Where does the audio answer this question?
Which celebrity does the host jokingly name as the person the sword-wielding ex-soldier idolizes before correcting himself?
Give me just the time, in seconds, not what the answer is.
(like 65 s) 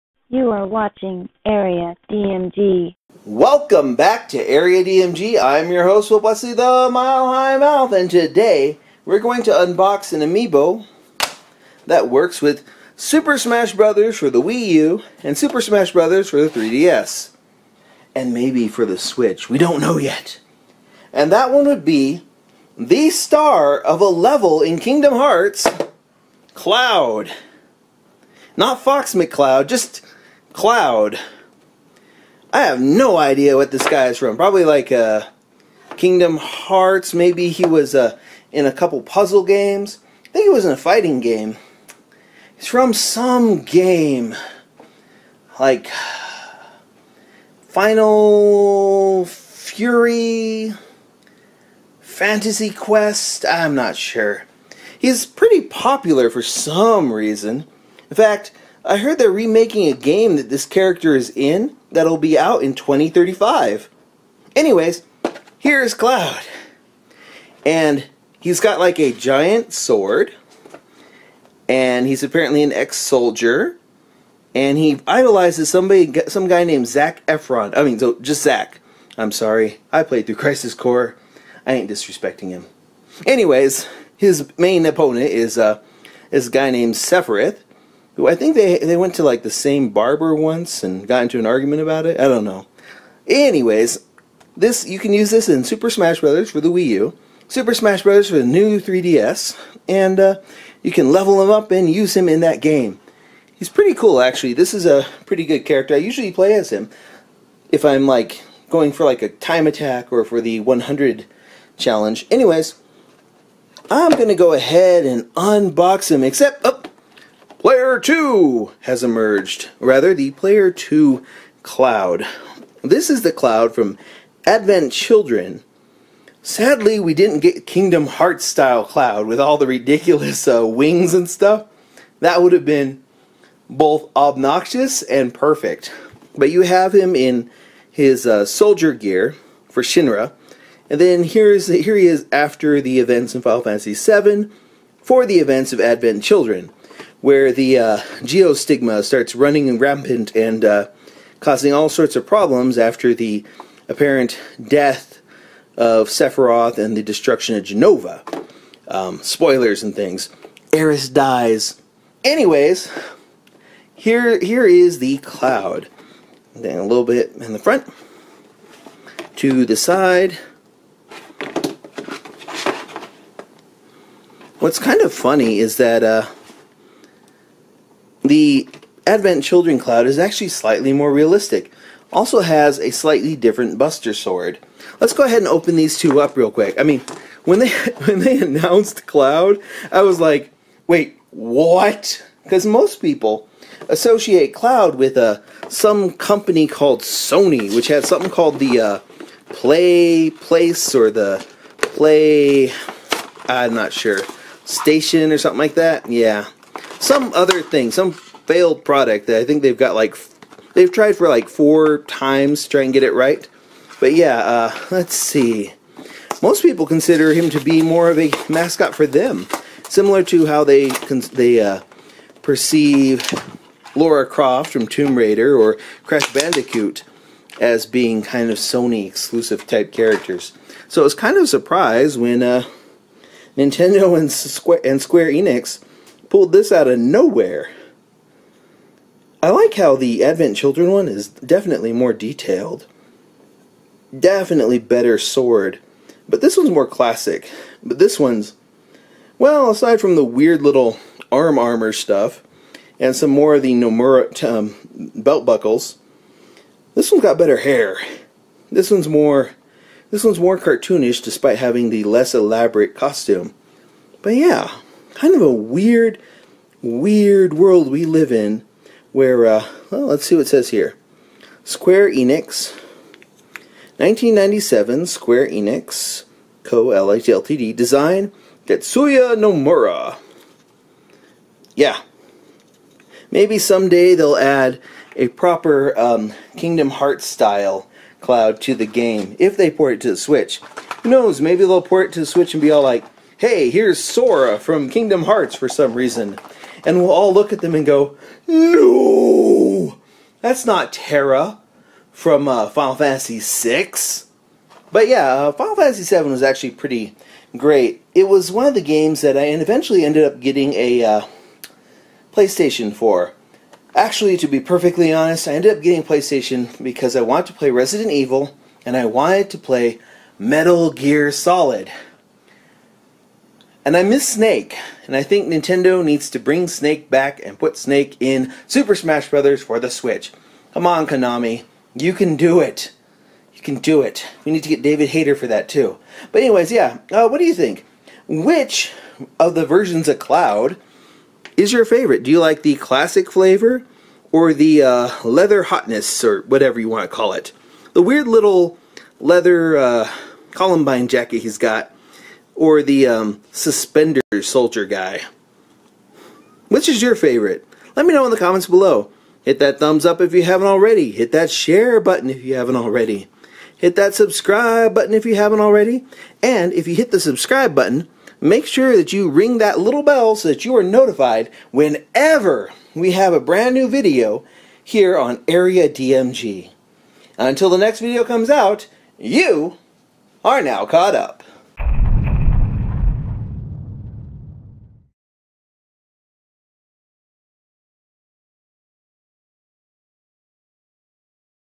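76 s.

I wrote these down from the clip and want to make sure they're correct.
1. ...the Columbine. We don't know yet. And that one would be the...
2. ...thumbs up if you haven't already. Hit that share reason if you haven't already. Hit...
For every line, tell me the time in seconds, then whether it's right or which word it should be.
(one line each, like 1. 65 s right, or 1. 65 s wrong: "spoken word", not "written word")
1. 18 s wrong: "Switch", not "Columbine"
2. 359 s wrong: "button", not "reason".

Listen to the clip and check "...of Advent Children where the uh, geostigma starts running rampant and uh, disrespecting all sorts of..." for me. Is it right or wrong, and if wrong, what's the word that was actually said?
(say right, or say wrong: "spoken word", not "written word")
wrong: "causing", not "disrespecting".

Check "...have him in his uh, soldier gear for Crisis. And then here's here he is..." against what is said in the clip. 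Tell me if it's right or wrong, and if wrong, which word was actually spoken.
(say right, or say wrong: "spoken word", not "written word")
wrong: "Shinra", not "Crisis".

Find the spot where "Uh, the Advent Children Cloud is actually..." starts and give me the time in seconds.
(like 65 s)
176 s.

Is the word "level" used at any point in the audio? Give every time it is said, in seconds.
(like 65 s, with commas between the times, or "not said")
24 s, 101 s.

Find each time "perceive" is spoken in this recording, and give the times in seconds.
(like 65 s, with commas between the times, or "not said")
222 s.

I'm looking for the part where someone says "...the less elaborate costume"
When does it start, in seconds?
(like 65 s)
261 s.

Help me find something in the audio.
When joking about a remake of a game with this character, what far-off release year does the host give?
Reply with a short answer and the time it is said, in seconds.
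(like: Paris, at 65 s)
2035, at 62 s.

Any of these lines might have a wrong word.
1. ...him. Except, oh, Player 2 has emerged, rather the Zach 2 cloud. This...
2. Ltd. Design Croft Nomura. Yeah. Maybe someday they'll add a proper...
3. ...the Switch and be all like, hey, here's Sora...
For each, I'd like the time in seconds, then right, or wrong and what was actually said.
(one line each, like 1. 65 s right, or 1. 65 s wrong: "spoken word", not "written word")
1. 116 s wrong: "Player", not "Zach"
2. 276 s wrong: "Tetsuya", not "Croft"
3. 292 s right.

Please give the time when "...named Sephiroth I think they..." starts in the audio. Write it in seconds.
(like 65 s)
86 s.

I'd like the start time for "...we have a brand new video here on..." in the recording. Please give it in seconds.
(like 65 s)
372 s.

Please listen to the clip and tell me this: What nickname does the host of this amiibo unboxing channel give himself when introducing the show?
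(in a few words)
The Mile High Mouth.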